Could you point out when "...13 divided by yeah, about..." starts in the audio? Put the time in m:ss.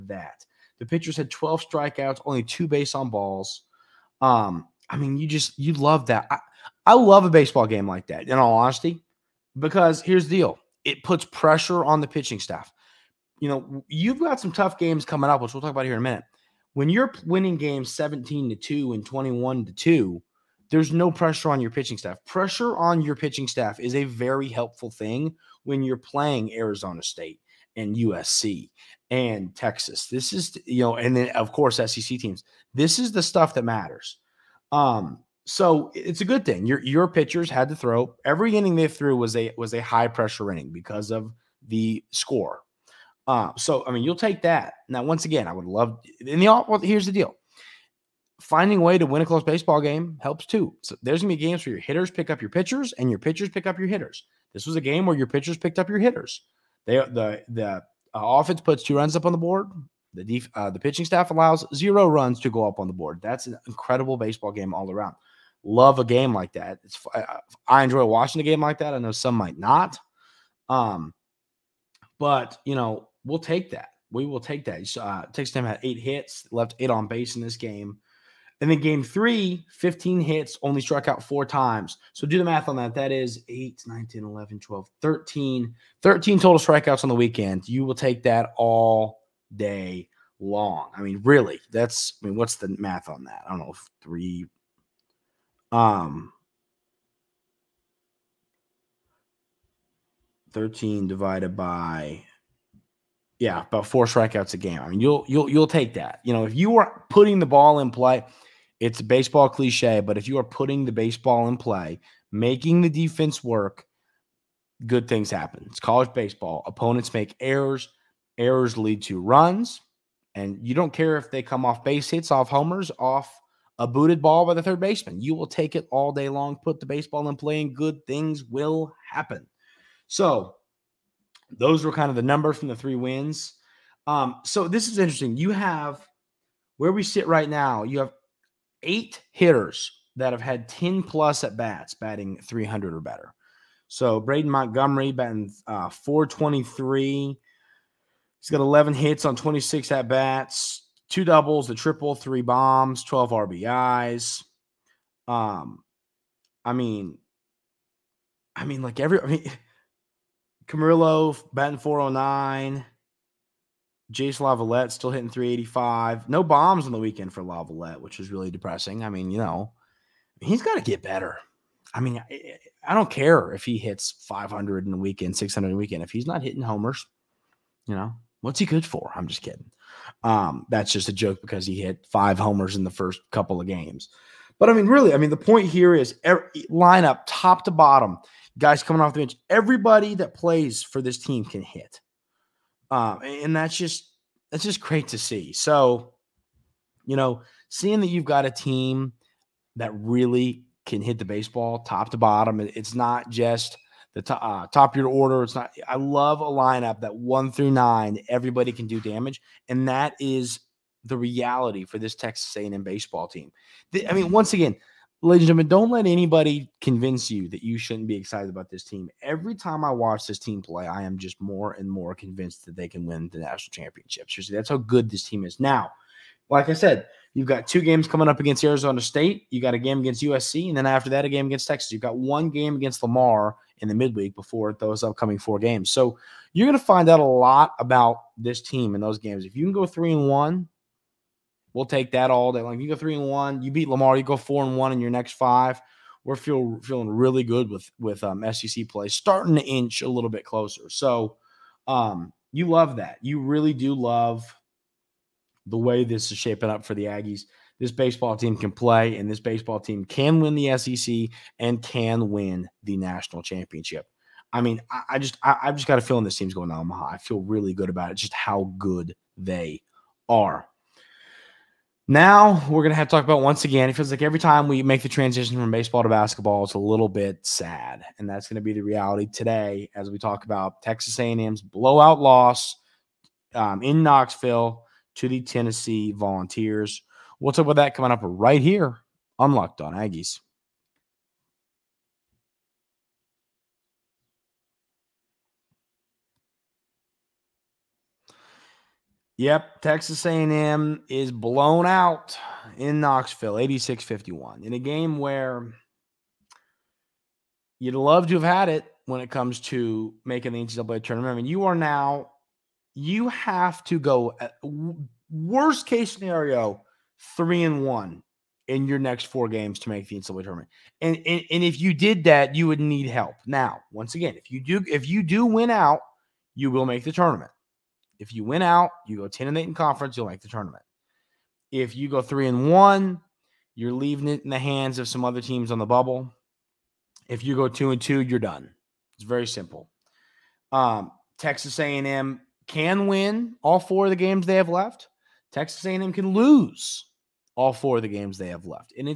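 1:40.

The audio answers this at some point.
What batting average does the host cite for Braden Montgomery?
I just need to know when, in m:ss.
2:25.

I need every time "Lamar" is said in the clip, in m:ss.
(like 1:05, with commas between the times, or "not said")
3:53, 4:03.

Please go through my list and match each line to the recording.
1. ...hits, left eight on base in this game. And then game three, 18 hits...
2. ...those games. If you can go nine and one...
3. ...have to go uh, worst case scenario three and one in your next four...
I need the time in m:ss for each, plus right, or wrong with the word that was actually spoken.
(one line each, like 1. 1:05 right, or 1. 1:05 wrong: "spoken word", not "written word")
1. 1:15 wrong: "15", not "18"
2. 3:59 wrong: "three", not "nine"
3. 5:13 right.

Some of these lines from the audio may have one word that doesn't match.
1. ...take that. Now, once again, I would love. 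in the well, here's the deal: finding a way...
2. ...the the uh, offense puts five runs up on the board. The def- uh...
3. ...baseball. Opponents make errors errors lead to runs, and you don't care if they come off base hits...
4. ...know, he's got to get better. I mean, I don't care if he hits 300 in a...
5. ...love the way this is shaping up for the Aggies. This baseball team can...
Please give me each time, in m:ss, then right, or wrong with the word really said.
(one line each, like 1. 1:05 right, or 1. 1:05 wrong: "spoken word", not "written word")
1. 0:44 right
2. 0:56 wrong: "two", not "five"
3. 1:56 right
4. 2:49 wrong: "500", not "300"
5. 4:13 right.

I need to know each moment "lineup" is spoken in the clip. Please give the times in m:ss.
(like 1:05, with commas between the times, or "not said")
3:06, 3:26.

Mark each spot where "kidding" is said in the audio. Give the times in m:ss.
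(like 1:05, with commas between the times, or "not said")
2:59.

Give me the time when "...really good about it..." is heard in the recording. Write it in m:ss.
4:27.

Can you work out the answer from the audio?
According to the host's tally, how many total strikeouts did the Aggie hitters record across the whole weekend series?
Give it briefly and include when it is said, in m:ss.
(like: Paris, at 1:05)
13, at 1:26.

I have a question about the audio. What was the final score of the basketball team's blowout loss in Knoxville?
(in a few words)
86-51.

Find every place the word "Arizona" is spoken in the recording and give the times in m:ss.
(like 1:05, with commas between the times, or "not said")
0:26, 3:48.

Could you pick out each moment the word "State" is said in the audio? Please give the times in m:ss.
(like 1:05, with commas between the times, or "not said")
0:27, 3:48.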